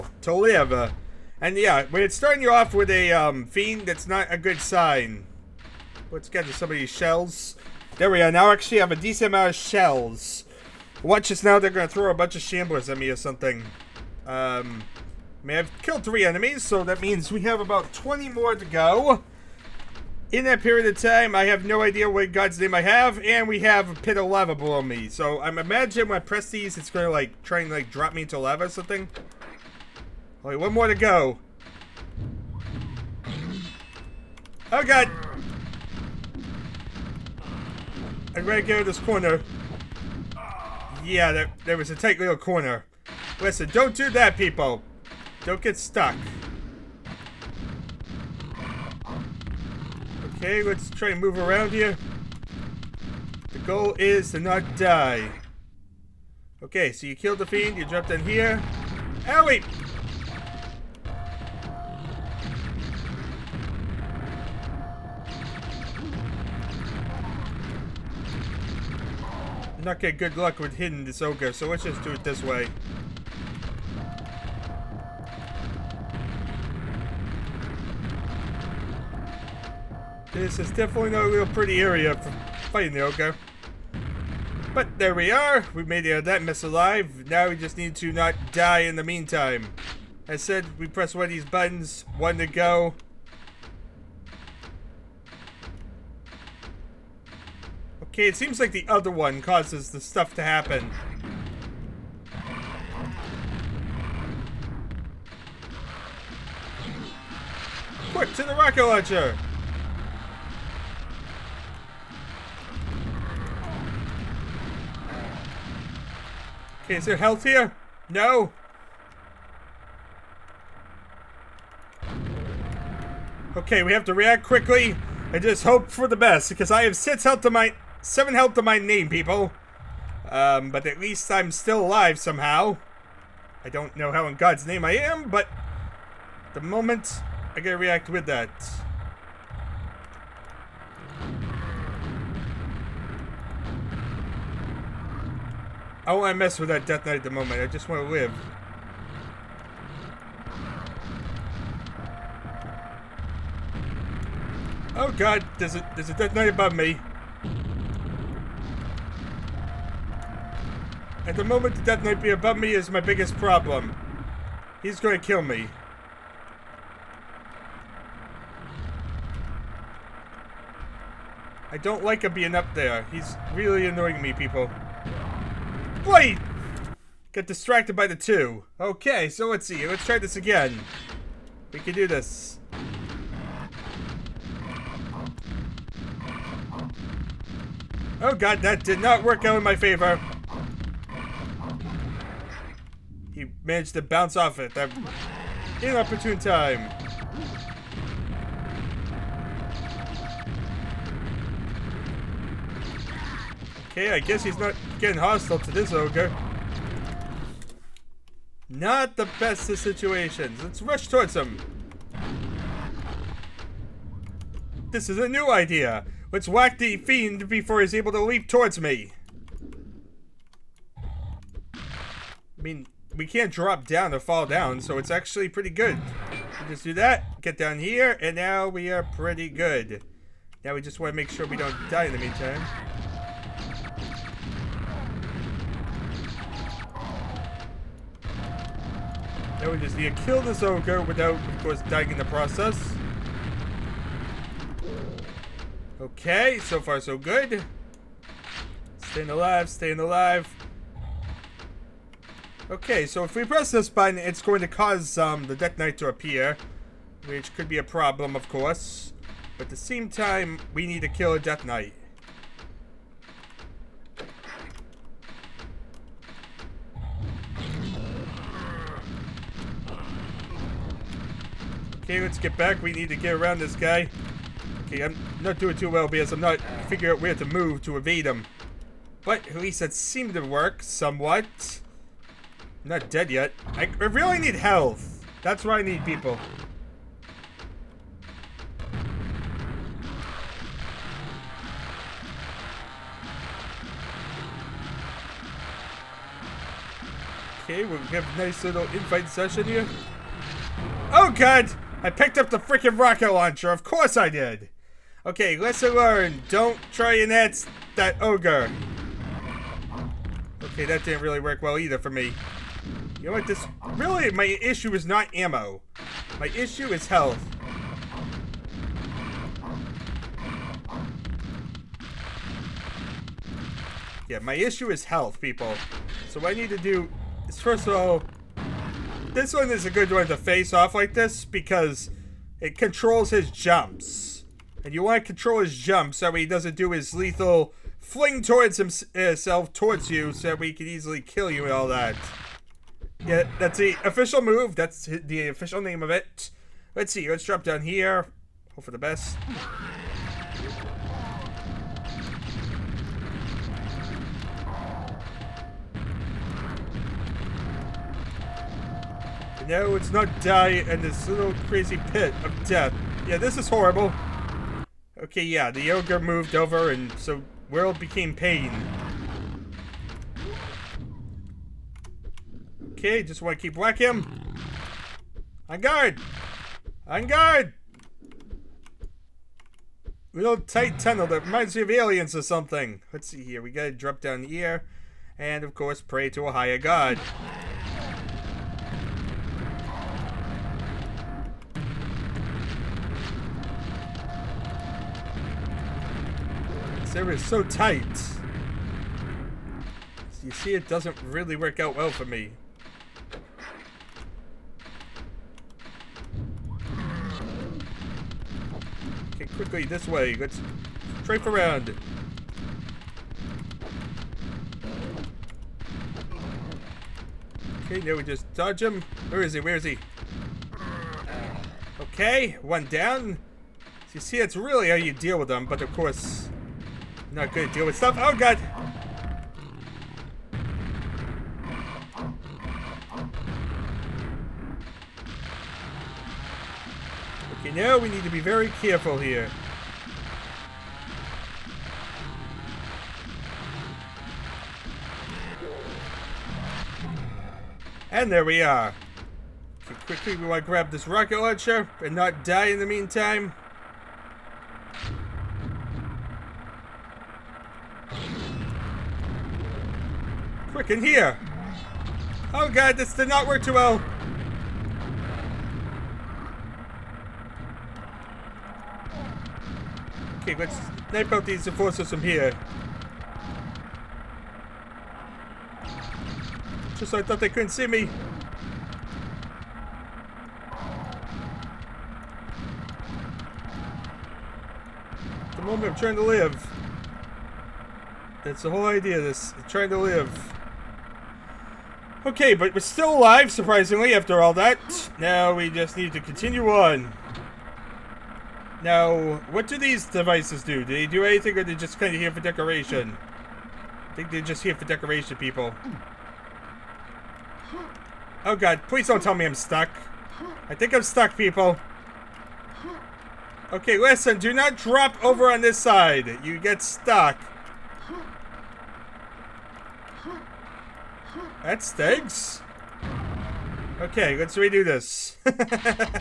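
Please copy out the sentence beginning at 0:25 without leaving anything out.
So I'm imagine when I press these, it's going to like try and like drop me into lava or something.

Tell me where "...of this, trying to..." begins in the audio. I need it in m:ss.
8:09.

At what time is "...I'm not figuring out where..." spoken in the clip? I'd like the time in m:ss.
4:36.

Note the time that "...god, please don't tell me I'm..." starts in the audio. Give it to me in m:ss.
8:28.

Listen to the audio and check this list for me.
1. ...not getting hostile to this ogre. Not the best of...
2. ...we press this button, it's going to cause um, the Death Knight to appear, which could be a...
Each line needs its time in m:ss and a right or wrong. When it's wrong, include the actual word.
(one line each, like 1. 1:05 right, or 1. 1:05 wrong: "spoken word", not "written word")
1. 3:24 right
2. 4:13 right.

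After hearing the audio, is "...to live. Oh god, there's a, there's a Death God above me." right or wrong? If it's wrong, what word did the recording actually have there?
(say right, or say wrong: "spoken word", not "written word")
wrong: "Knight", not "God".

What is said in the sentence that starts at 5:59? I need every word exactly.
No, it's not die in this little crazy pit of death.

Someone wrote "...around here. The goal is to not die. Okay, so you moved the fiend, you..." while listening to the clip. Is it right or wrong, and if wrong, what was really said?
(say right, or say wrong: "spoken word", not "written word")
wrong: "killed", not "moved".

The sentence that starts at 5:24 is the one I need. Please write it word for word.
Yeah, my issue is health, people.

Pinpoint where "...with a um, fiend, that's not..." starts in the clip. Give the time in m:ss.
0:02.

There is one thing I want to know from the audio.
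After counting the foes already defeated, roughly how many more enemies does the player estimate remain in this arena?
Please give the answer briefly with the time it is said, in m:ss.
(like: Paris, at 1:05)
20, at 0:17.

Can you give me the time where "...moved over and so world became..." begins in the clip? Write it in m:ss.
6:06.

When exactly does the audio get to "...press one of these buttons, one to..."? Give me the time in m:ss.
1:30.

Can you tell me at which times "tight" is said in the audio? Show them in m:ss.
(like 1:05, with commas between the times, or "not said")
0:41, 6:20, 6:37.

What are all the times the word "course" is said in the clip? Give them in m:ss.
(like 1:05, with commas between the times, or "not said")
4:01, 4:18, 5:03, 6:25, 7:05.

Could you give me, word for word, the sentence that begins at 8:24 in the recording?
I think they're just here for decoration, people.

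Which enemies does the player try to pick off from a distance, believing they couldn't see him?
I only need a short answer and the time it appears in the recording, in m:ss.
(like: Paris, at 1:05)
enforcers, at 7:51.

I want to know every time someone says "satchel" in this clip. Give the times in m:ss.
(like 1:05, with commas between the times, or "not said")
not said.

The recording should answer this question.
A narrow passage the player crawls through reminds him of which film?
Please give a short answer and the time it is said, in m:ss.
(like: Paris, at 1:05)
Aliens, at 6:21.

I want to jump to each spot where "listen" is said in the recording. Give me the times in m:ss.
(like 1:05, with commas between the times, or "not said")
0:43, 8:33.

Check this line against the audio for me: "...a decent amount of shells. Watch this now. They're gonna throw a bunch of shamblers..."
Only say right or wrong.
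right.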